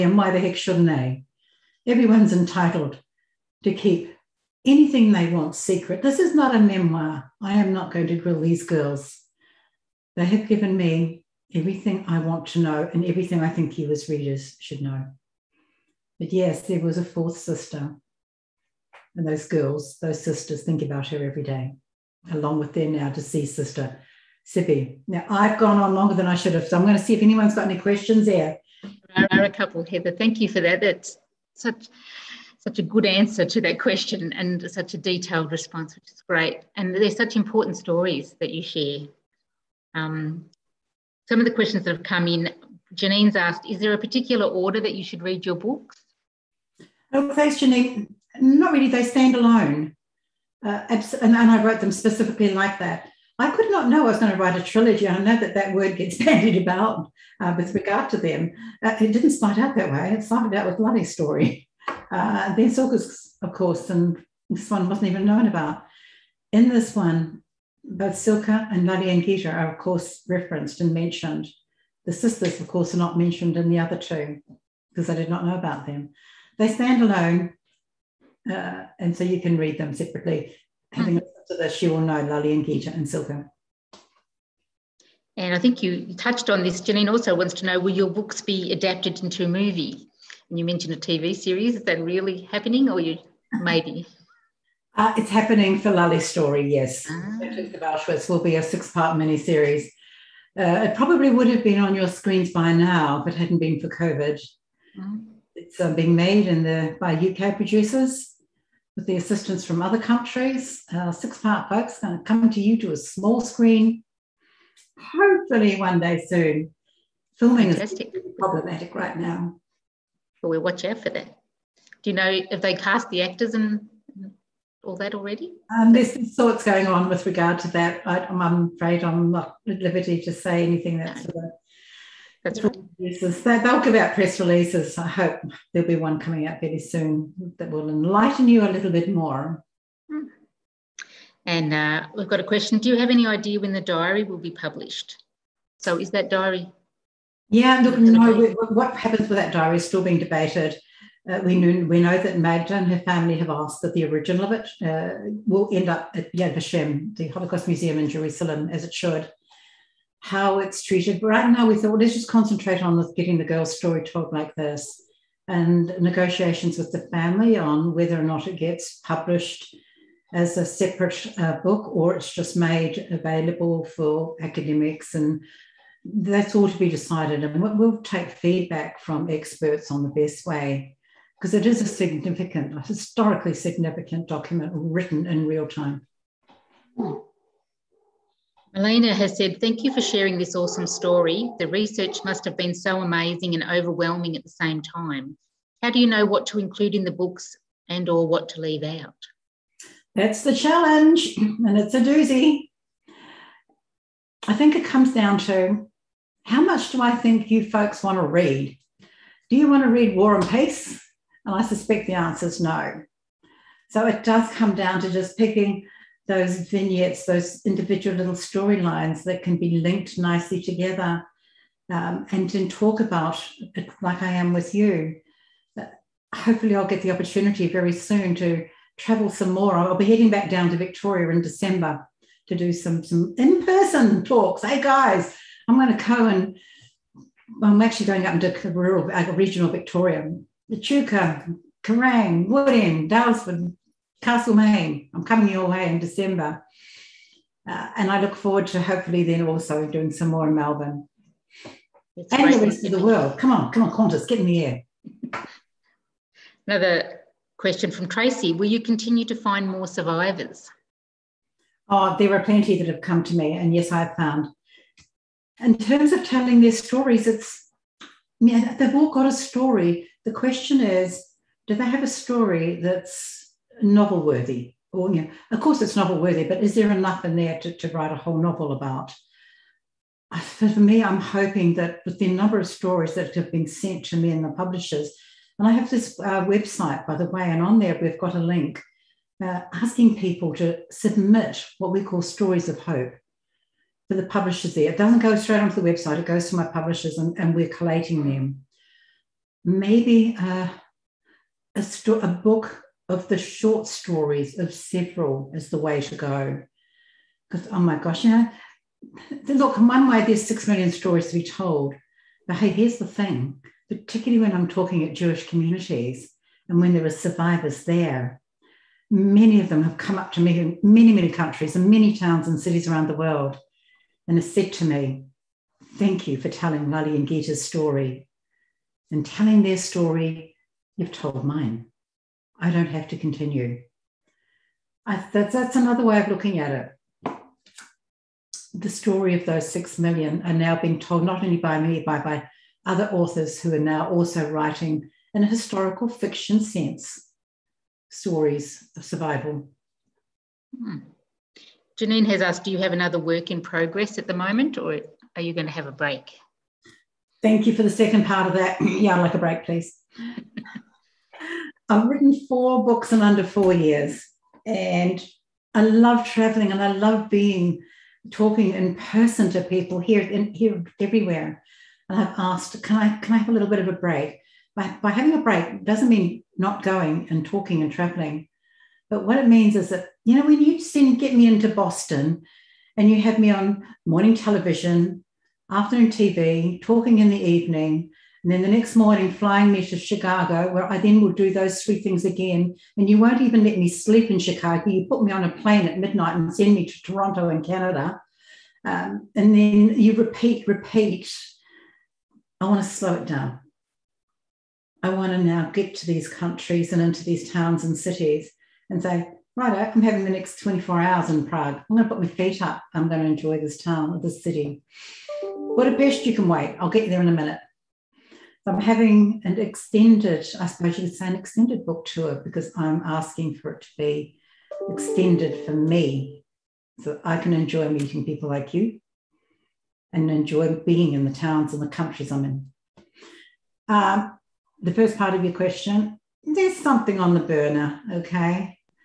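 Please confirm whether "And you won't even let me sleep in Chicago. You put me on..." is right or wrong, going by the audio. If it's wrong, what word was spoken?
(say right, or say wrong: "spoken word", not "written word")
right.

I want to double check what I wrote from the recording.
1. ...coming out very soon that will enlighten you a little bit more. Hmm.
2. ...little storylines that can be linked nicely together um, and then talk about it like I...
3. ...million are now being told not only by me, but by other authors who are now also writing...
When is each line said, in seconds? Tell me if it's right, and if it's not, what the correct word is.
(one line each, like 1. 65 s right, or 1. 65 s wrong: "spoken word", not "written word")
1. 136 s right
2. 218 s right
3. 339 s right.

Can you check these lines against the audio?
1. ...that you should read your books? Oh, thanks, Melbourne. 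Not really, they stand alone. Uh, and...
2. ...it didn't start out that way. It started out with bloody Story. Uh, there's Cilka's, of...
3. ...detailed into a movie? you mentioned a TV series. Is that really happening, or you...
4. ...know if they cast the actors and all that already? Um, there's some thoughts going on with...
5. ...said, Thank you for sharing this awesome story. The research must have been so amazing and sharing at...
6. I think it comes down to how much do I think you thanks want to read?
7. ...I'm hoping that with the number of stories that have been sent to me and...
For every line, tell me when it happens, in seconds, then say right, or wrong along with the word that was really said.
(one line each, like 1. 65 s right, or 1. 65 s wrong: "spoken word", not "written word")
1. 44 s wrong: "Janine", not "Melbourne"
2. 59 s right
3. 88 s wrong: "adapted", not "detailed"
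4. 122 s right
5. 189 s wrong: "overwhelming", not "sharing"
6. 204 s wrong: "folks", not "thanks"
7. 281 s right.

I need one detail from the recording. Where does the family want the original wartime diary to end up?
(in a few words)
Yad Vashem.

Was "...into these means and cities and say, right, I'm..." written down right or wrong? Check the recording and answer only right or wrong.
wrong.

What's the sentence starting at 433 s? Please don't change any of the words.
Um, the first part of your question, there's something on the burner, okay?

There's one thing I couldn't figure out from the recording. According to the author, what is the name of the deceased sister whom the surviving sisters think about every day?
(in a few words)
Cibi.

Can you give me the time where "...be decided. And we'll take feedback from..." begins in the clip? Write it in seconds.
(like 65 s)
176 s.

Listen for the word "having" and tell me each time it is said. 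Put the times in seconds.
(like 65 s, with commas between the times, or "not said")
80 s, 375 s, 410 s, 418 s.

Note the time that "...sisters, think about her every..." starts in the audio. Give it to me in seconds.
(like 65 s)
20 s.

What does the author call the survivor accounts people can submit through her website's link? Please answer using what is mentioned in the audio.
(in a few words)
stories of hope.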